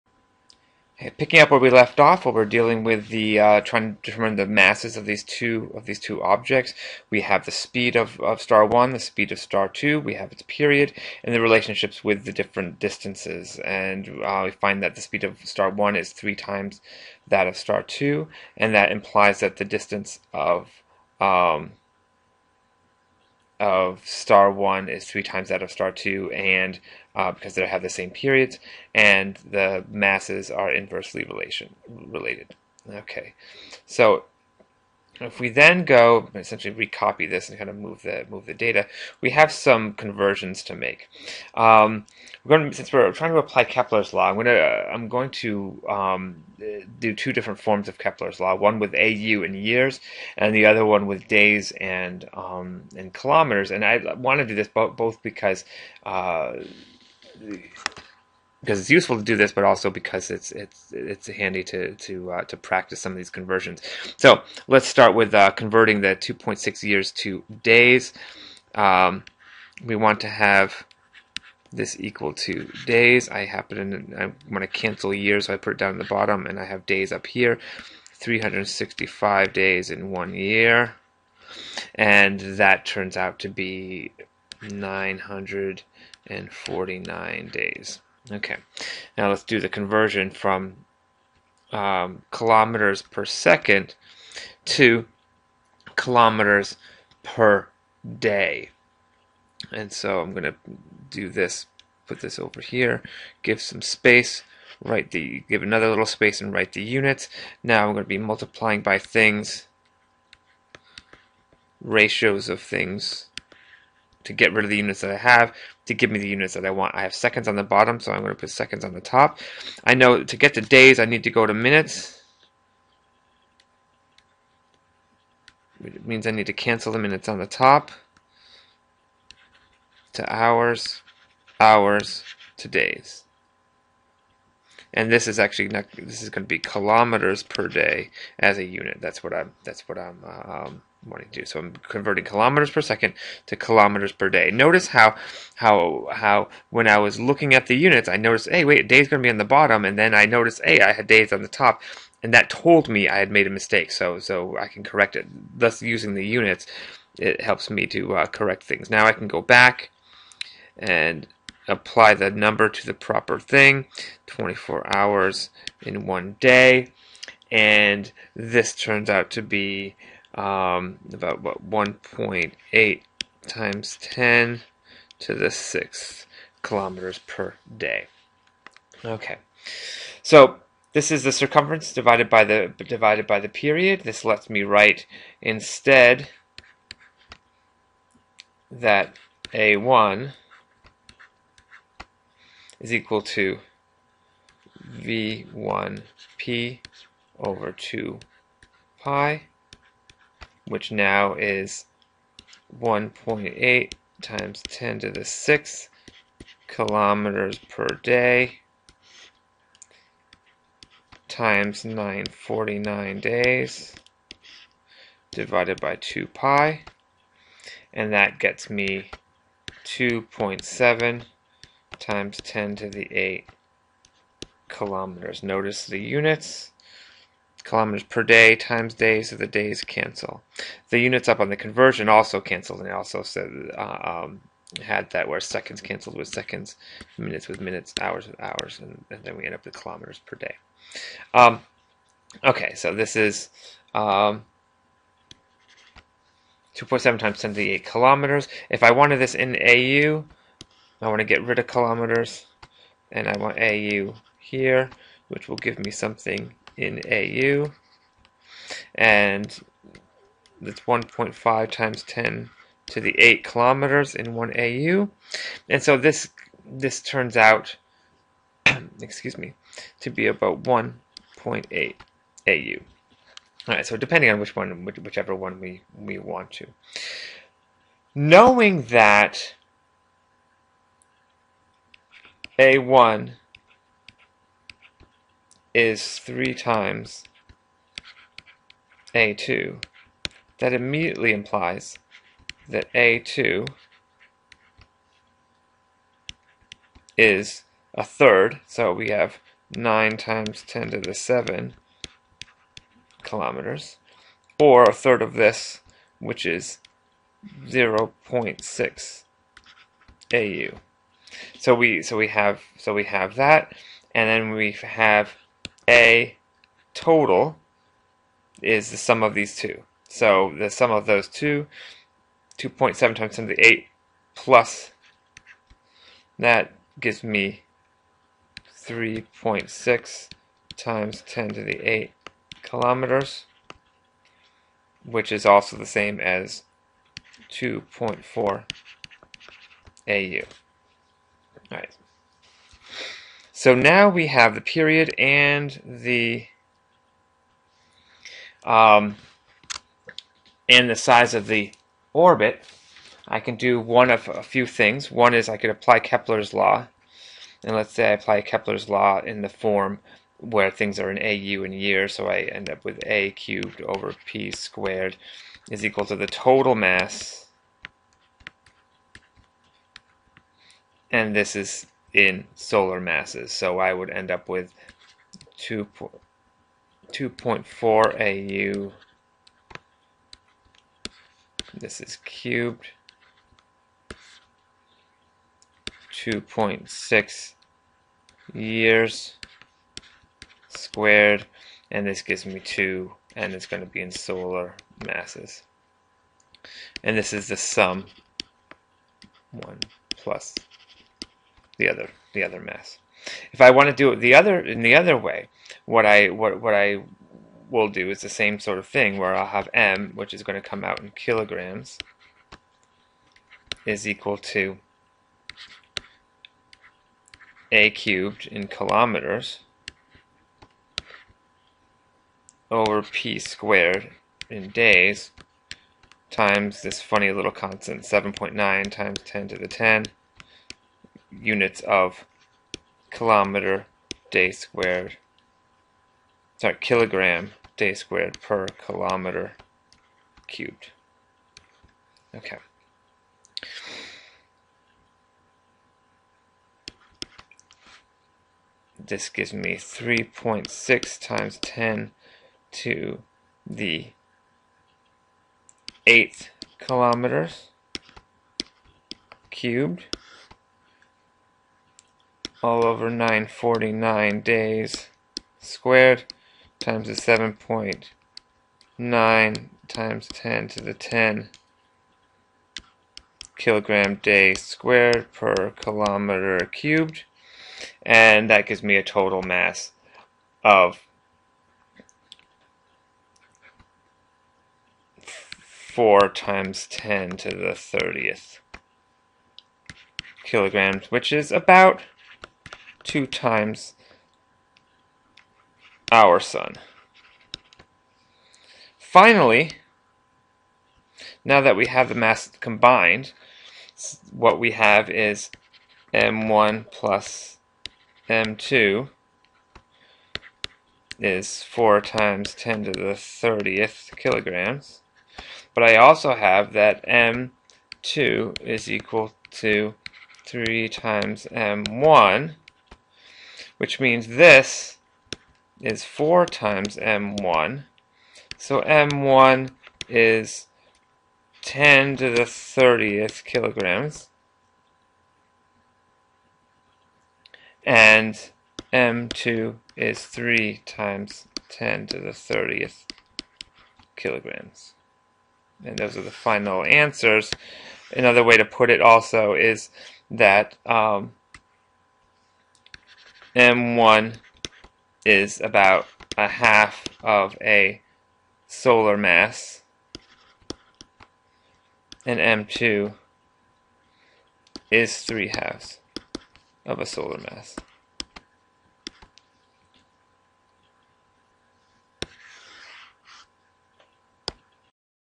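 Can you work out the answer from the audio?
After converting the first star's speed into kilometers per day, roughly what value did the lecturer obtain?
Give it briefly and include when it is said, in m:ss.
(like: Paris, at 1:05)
1.8 × 10^6 km/day, at 2:51.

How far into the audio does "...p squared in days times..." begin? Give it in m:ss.
7:03.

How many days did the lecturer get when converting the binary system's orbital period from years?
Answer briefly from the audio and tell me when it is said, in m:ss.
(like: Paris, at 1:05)
949 days, at 1:24.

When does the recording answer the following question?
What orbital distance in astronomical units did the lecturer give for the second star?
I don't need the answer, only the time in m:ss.
5:07.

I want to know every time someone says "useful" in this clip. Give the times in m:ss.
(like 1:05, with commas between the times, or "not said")
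0:58.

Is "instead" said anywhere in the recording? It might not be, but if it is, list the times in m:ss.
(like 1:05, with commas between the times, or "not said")
3:05.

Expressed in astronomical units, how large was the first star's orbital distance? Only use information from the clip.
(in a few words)
1.8 AU.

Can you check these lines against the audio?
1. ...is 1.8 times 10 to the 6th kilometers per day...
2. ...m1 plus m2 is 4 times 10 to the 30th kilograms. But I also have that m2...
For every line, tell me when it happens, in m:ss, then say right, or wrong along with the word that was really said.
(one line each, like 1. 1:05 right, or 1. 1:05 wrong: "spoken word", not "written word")
1. 3:21 right
2. 8:26 right.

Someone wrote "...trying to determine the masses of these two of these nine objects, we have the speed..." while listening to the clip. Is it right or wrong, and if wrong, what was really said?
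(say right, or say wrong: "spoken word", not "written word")
wrong: "two", not "nine".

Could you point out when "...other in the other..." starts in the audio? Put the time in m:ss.
6:44.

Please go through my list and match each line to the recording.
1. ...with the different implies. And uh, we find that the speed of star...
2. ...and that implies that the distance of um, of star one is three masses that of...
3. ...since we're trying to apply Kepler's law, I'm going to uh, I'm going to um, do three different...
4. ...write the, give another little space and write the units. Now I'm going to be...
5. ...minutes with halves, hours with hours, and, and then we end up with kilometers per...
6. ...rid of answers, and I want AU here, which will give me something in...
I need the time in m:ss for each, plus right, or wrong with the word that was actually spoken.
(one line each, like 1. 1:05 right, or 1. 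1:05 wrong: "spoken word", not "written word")
1. 0:12 wrong: "distances", not "implies"
2. 0:18 wrong: "times", not "masses"
3. 0:42 wrong: "two", not "three"
4. 1:44 right
5. 3:57 wrong: "minutes", not "halves"
6. 4:11 wrong: "kilometers", not "answers".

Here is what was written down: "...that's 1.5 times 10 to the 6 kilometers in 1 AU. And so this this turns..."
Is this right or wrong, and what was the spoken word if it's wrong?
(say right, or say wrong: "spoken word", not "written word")
wrong: "8", not "6".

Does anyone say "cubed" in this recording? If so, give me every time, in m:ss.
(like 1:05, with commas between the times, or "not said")
6:03, 6:22, 6:57, 7:20, 7:39, 7:56.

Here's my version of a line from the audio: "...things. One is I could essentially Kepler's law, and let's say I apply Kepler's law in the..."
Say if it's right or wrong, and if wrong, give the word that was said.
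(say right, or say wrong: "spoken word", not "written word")
wrong: "apply", not "essentially".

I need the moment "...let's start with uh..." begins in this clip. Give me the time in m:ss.
1:04.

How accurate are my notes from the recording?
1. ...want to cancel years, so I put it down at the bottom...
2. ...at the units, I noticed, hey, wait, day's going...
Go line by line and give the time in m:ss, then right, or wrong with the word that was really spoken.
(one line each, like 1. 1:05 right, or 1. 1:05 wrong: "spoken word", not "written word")
1. 1:14 right
2. 2:27 right.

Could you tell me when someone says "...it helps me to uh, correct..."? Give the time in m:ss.
2:37.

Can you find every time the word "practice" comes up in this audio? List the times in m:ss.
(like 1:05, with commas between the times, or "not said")
1:02.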